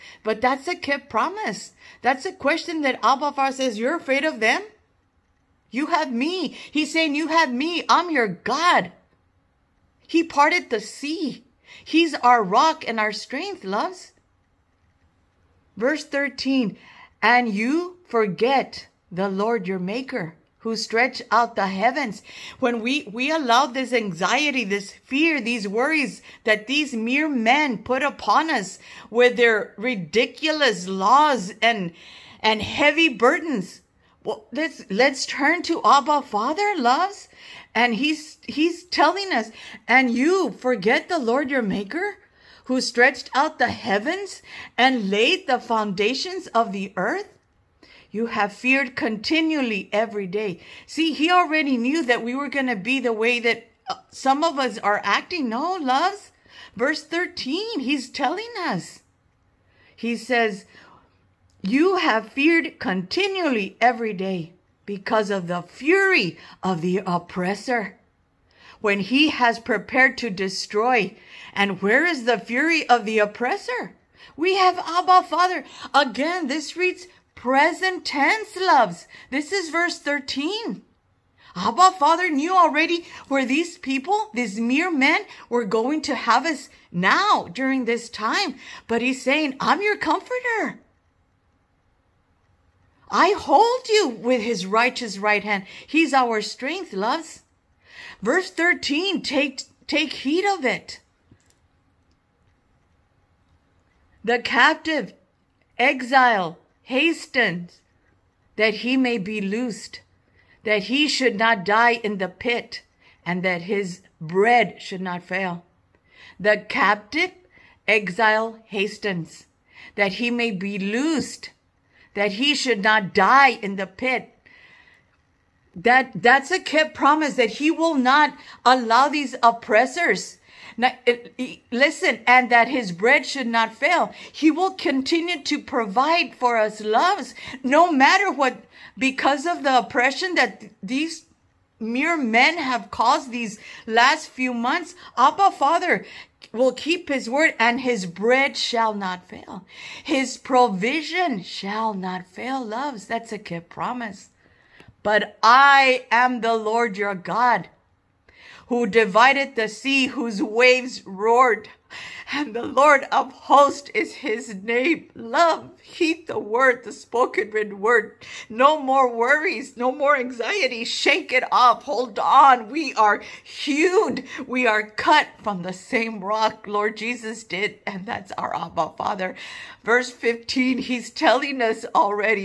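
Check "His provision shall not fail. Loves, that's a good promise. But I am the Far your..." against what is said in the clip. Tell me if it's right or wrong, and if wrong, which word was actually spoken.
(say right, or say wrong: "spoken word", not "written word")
wrong: "Lord", not "Far".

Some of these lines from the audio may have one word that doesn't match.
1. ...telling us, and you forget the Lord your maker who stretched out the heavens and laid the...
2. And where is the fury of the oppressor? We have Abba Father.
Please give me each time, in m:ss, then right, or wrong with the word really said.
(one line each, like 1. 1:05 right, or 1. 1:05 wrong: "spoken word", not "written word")
1. 0:38 right
2. 1:11 right.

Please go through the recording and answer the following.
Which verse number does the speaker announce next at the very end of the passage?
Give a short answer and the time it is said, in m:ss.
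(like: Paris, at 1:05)
15, at 2:59.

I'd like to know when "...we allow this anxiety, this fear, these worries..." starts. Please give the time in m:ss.
0:23.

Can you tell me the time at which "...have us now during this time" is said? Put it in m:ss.
1:26.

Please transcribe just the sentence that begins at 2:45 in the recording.
Love, heed the word, the spoken written word.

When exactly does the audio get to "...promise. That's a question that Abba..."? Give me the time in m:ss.
0:01.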